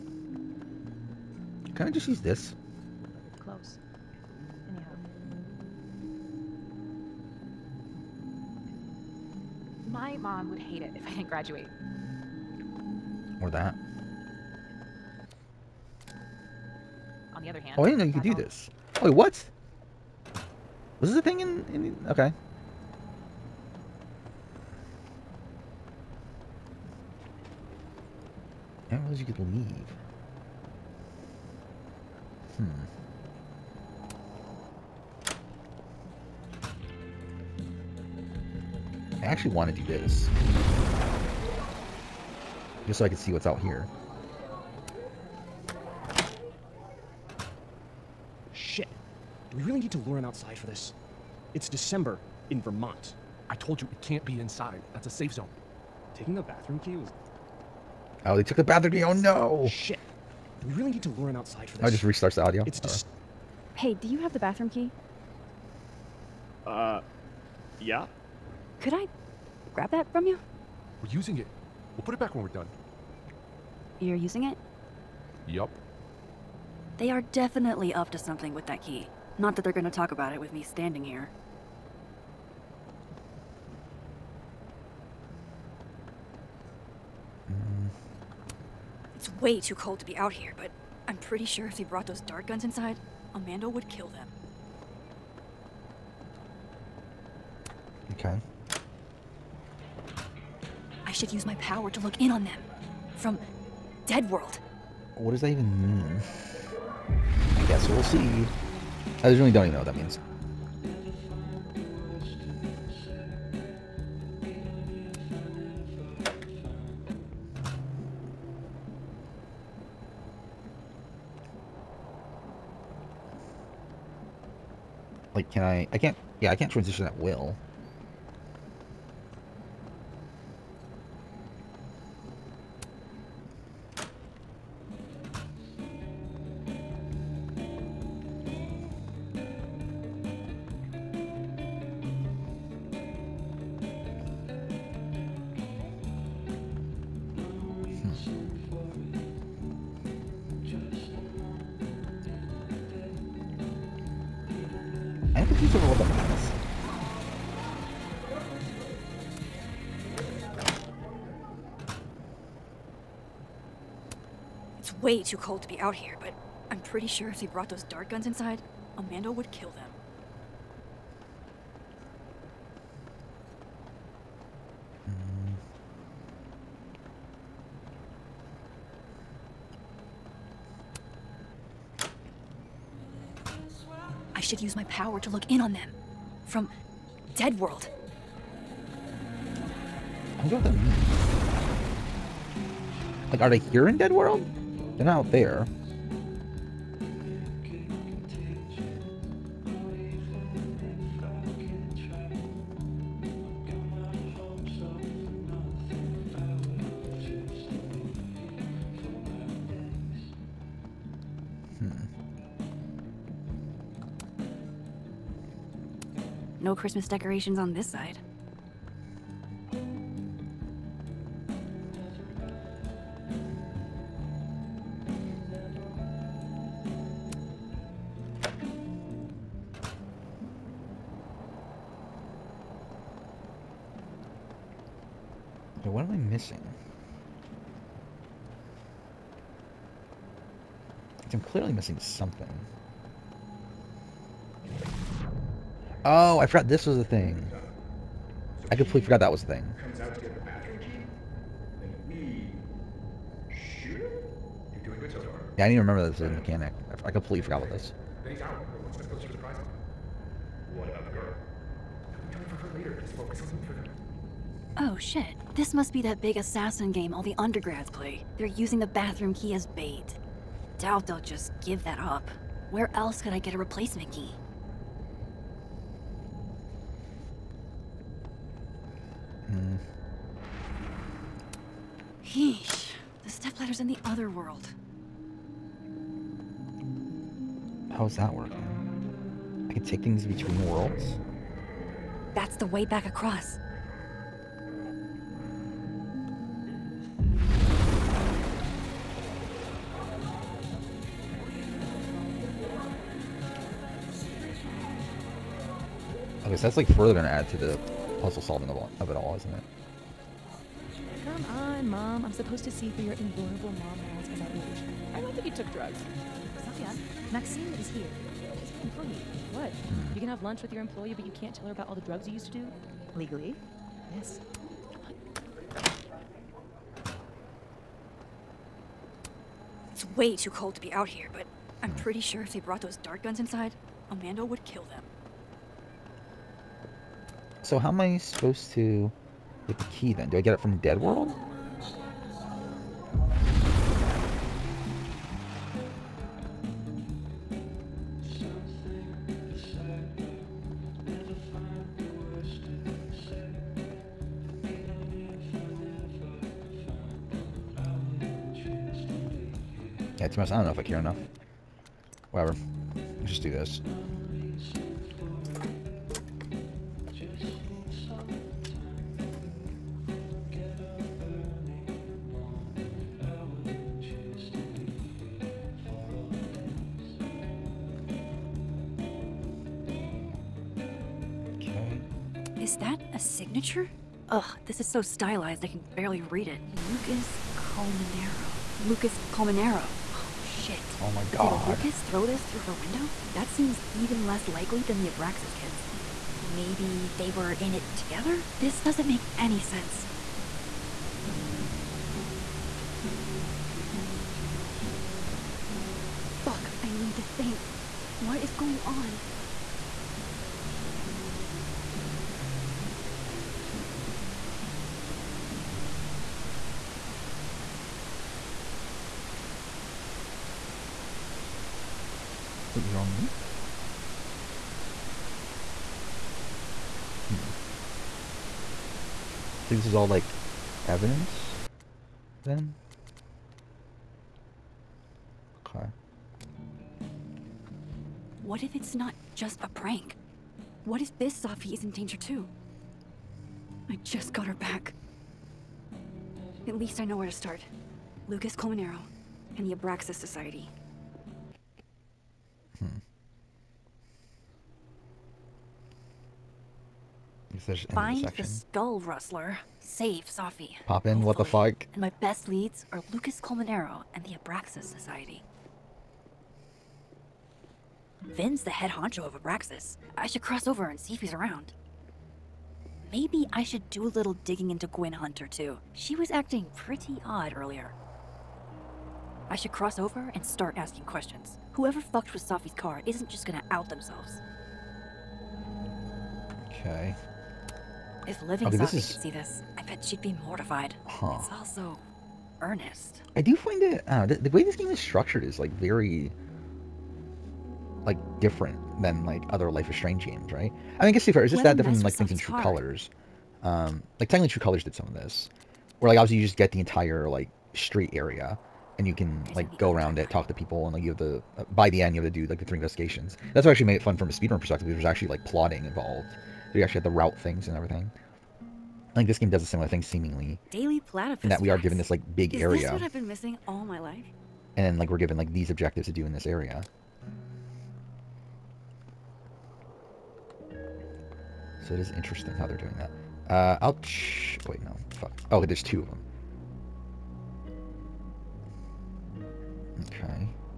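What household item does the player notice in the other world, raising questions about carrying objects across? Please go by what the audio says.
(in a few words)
The stepladder.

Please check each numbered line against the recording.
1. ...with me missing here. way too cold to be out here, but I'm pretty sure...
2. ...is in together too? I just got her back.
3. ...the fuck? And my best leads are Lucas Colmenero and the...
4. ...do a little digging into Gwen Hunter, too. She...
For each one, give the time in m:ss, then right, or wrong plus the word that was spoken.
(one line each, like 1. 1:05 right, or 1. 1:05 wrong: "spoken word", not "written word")
1. 1:20 wrong: "standing", not "missing"
2. 7:21 wrong: "danger", not "together"
3. 7:41 right
4. 7:53 right.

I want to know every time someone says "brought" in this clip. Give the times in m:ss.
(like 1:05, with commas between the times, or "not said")
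1:31, 2:47, 5:32.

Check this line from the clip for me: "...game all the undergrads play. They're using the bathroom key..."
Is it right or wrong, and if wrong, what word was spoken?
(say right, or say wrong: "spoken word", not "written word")
right.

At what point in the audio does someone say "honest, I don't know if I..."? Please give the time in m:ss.
6:00.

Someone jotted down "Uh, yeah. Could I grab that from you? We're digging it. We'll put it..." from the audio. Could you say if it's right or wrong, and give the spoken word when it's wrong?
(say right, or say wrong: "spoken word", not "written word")
wrong: "using", not "digging".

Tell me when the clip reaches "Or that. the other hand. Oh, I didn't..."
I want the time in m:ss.
0:13.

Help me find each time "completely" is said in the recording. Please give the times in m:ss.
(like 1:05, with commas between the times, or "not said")
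4:08, 4:17.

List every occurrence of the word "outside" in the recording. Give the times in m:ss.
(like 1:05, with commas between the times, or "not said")
0:50, 1:01.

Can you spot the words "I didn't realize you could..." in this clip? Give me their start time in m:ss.
0:28.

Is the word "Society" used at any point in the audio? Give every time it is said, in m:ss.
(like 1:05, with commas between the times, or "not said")
7:30, 7:44.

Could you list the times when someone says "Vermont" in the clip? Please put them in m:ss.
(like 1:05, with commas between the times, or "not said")
0:52.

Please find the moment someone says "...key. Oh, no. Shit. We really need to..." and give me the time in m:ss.
0:58.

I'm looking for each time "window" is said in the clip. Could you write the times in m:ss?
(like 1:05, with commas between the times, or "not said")
6:32.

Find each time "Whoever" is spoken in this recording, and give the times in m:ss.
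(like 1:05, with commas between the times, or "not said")
8:01.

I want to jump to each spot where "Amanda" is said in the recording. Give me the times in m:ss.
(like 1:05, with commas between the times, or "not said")
1:33, 2:48, 5:34.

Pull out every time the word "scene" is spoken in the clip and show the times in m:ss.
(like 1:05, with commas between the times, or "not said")
not said.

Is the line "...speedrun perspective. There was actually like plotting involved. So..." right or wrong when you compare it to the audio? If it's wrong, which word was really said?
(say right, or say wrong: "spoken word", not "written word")
right.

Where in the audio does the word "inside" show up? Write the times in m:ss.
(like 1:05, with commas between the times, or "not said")
0:54, 1:32, 2:48, 5:33.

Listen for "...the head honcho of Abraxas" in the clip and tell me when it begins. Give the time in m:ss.
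7:48.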